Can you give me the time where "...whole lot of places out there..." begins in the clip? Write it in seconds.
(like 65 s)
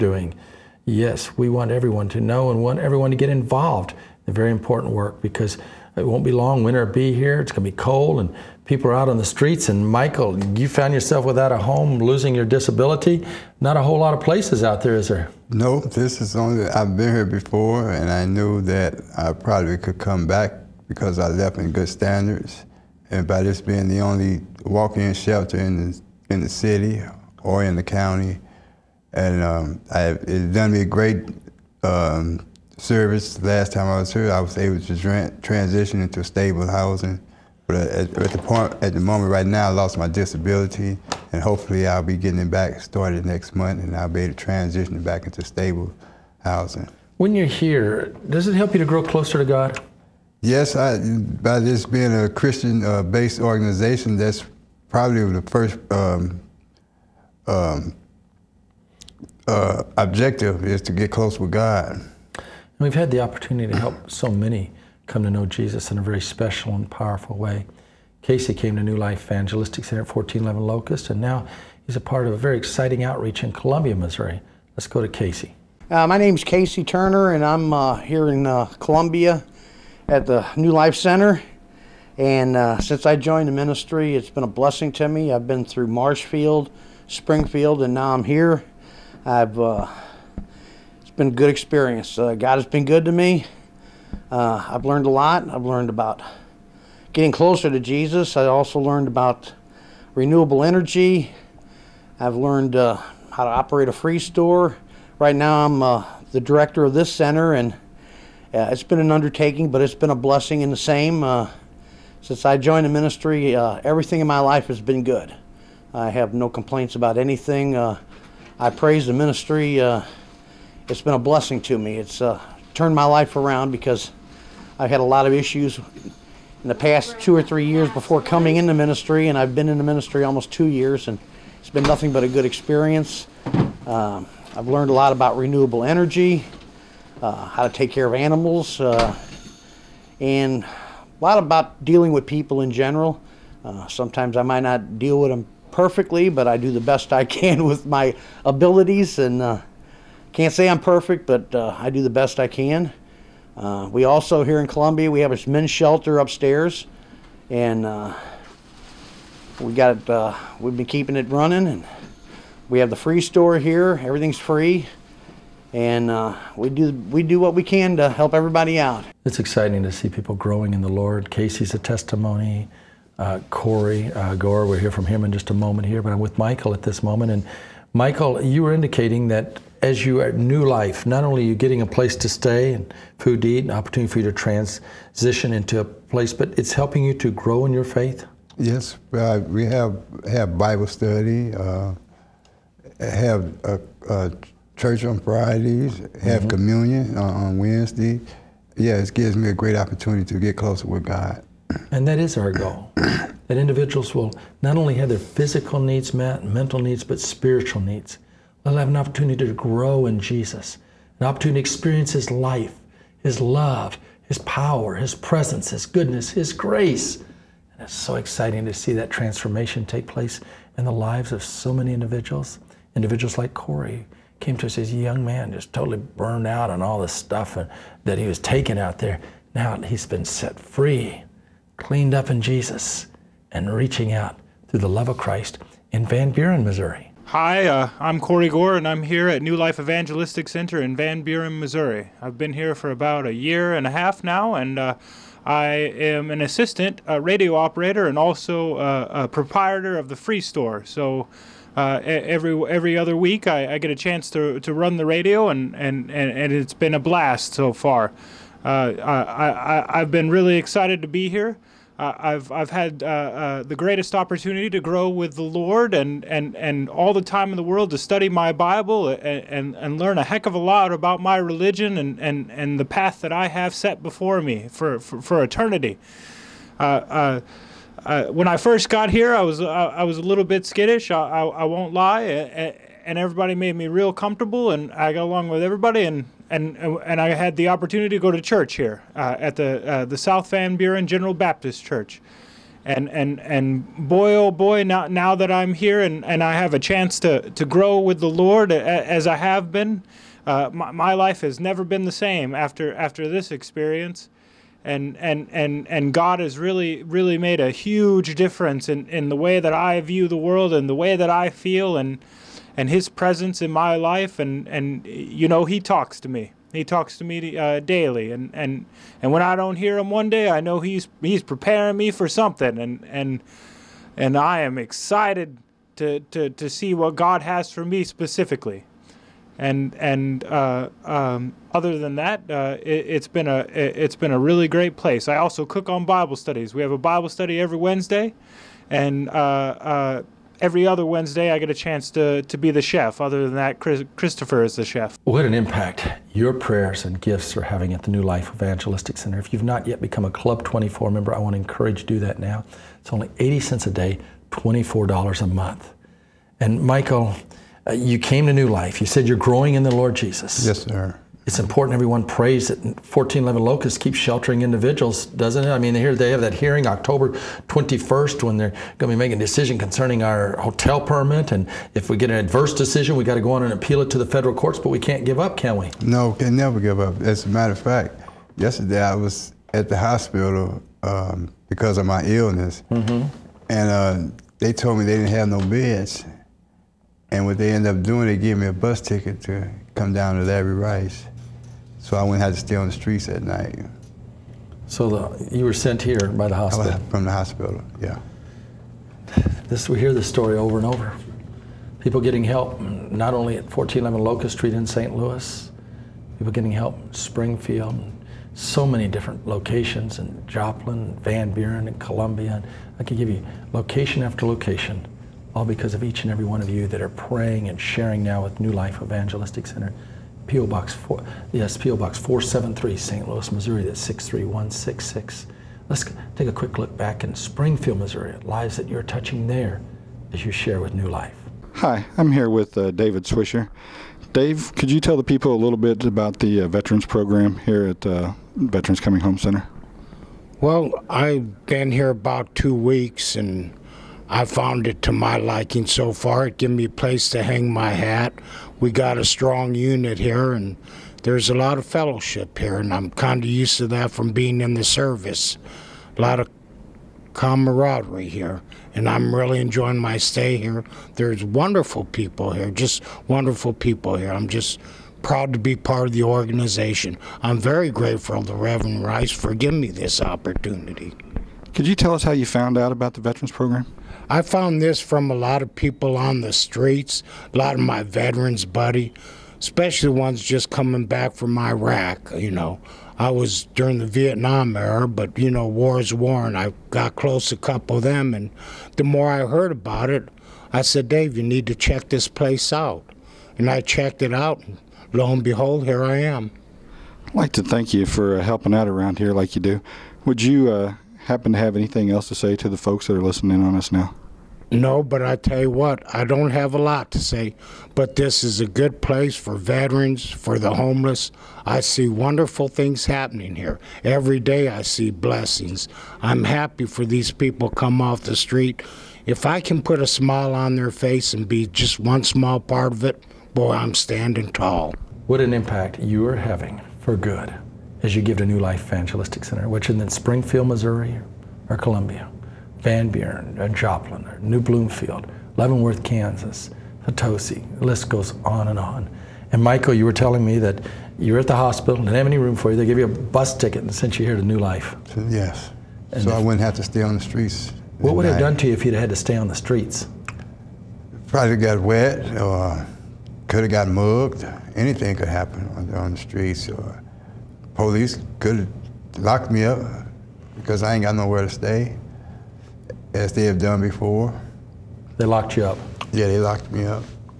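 13 s.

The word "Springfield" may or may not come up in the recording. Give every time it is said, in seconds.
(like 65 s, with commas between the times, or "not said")
87 s, 407 s, 427 s, 530 s.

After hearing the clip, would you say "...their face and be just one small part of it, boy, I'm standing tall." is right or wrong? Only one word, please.
right.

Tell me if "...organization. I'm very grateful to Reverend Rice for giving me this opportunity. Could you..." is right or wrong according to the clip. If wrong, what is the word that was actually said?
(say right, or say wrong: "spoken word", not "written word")
right.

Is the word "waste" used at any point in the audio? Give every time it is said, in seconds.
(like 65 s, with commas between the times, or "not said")
not said.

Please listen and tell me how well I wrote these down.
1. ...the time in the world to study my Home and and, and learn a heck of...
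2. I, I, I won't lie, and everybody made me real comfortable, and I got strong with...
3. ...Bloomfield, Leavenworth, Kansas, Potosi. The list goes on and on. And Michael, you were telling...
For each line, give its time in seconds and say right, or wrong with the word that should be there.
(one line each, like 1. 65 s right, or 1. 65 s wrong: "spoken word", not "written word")
1. 267 s wrong: "Bible", not "Home"
2. 281 s wrong: "along", not "strong"
3. 534 s right.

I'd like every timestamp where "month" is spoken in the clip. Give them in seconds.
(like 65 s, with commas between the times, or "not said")
43 s, 355 s.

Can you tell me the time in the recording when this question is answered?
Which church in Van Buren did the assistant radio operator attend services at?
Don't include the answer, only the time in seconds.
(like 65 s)
290 s.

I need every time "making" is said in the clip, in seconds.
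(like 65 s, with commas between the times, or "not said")
369 s.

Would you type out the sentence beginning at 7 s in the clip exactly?
It's going to be cold, and people are out on the streets.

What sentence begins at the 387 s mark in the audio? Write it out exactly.
And what they ended up doing, they gave me a bus ticket to come down to Larry Rice.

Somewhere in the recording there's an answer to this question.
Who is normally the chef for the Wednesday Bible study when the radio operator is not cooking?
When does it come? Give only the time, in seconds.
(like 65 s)
344 s.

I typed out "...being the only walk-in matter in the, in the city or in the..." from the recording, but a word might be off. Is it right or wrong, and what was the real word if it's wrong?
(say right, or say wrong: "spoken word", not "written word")
wrong: "shelter", not "matter".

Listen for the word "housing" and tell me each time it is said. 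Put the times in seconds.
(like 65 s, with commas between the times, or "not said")
36 s, 46 s.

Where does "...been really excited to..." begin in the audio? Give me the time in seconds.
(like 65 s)
260 s.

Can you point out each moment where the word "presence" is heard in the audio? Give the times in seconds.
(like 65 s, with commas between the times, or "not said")
215 s, 313 s.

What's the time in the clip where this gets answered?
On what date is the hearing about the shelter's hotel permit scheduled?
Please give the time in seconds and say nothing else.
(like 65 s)
366 s.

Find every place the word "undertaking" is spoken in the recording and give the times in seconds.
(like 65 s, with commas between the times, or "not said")
109 s.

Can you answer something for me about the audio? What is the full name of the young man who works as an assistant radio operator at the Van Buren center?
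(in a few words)
Corey Gore.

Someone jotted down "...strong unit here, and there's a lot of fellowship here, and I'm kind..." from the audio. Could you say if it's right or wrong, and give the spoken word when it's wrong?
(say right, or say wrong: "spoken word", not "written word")
right.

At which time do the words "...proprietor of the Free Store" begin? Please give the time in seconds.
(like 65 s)
249 s.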